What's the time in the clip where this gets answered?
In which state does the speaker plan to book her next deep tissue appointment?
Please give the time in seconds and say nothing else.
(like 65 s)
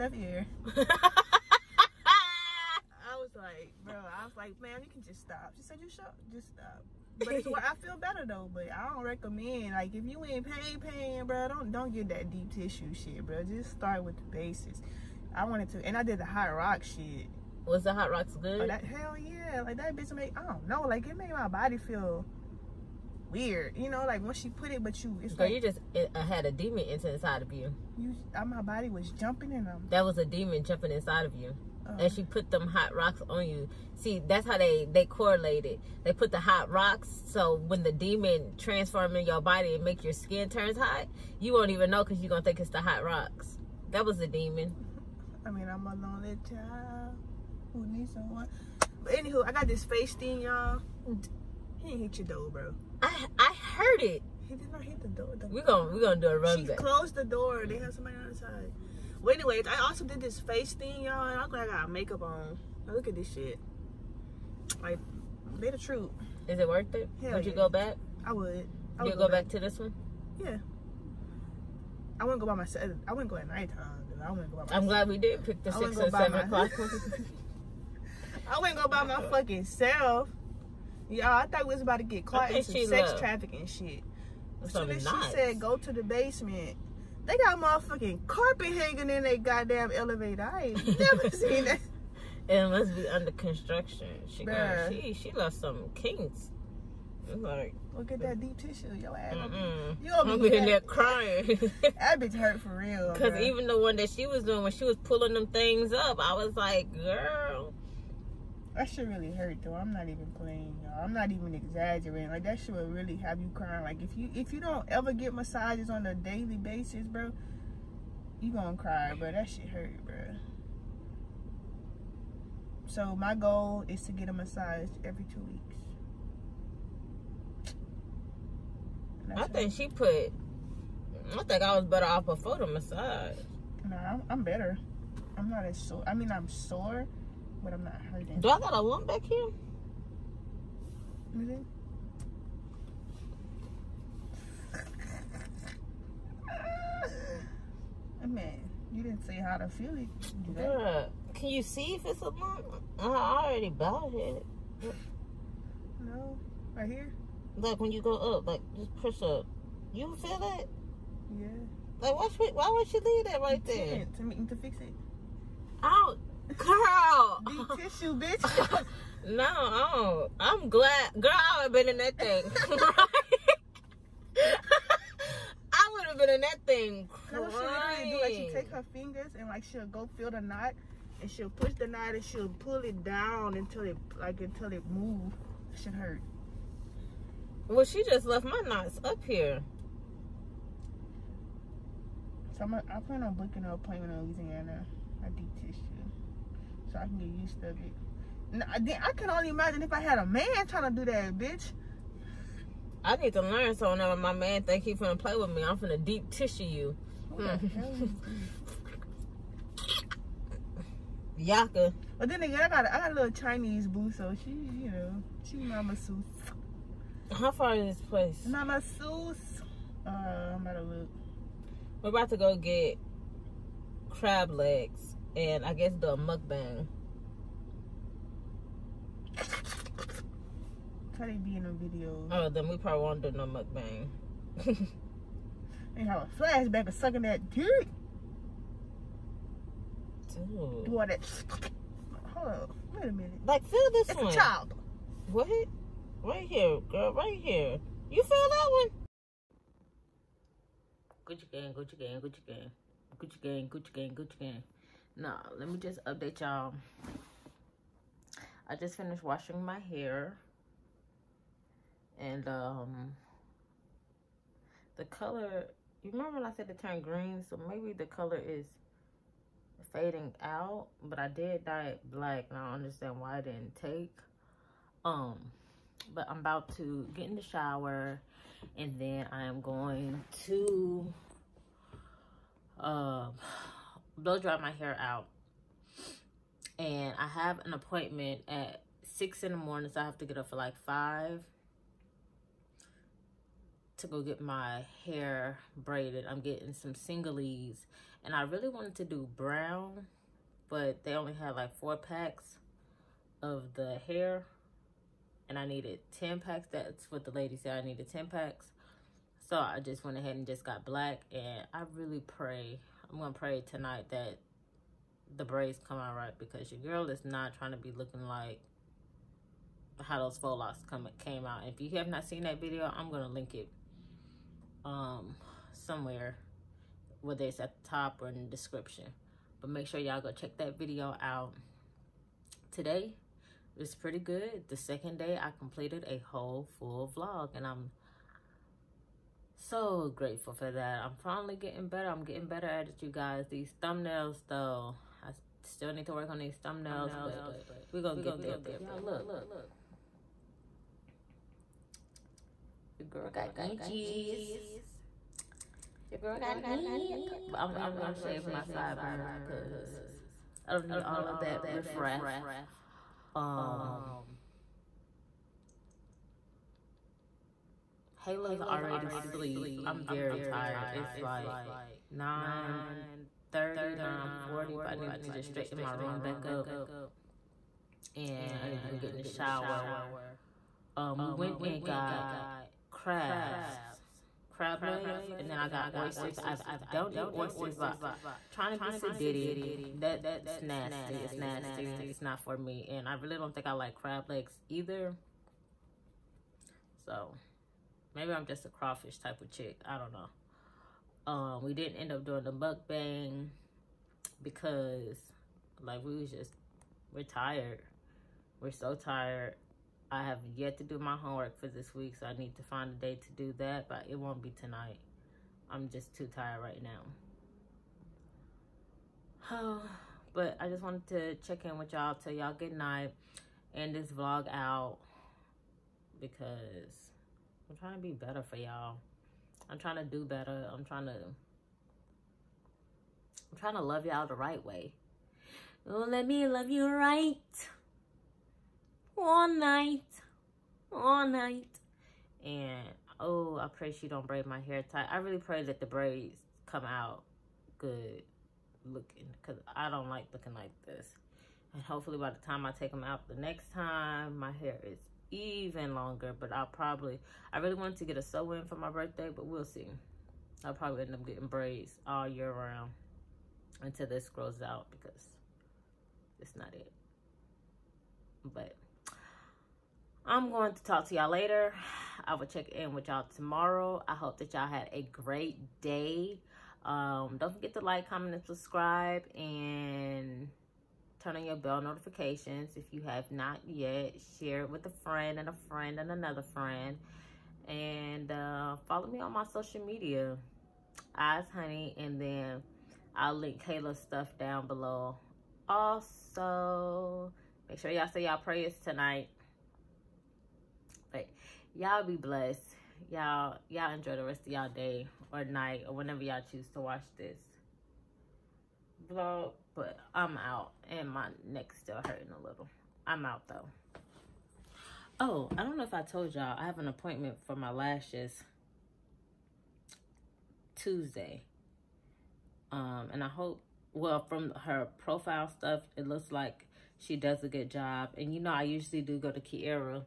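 194 s.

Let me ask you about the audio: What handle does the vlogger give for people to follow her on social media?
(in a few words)
Eyezhoney.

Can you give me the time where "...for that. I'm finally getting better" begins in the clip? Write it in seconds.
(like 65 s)
340 s.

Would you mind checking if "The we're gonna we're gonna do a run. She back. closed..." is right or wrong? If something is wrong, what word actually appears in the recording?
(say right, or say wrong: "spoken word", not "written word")
right.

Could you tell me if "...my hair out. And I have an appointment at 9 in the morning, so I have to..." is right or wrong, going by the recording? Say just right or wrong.
wrong.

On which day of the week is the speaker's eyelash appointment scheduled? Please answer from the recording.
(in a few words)
Tuesday.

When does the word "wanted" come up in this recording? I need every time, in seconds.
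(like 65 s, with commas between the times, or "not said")
15 s, 298 s, 420 s, 457 s.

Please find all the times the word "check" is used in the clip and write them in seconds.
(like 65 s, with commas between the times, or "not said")
330 s, 421 s, 472 s.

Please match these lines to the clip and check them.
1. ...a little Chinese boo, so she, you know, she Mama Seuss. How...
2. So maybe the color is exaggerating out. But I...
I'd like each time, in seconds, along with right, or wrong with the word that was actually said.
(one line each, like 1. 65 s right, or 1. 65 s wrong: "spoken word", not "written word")
1. 213 s right
2. 267 s wrong: "fading", not "exaggerating".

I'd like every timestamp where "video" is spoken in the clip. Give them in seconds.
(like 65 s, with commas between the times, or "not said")
231 s, 322 s, 330 s.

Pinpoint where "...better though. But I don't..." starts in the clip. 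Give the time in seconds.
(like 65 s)
7 s.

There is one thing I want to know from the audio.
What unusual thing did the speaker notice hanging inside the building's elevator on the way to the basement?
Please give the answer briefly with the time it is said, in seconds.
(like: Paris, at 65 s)
carpet, at 88 s.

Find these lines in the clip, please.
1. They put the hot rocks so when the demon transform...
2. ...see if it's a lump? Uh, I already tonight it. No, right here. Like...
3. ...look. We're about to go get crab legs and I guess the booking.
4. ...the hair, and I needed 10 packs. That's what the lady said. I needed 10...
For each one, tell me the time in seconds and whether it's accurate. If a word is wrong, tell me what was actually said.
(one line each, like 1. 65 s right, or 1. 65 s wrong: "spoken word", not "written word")
1. 36 s right
2. 151 s wrong: "bought", not "tonight"
3. 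220 s wrong: "mukbang", not "booking"
4. 303 s right.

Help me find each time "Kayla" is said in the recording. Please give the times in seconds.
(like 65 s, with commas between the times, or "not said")
368 s, 493 s.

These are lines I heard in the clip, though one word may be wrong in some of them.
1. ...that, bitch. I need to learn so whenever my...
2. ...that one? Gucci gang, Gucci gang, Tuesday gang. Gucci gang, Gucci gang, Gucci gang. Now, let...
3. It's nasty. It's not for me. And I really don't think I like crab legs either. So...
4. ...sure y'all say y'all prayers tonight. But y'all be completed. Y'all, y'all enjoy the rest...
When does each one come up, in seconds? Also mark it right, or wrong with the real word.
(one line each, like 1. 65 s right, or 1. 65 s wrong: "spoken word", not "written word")
1. 201 s right
2. 248 s wrong: "Gucci", not "Tuesday"
3. 391 s right
4. 497 s wrong: "blessed", not "completed".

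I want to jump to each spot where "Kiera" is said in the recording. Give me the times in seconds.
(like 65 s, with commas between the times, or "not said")
529 s.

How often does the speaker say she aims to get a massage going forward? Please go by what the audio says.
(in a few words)
every two weeks.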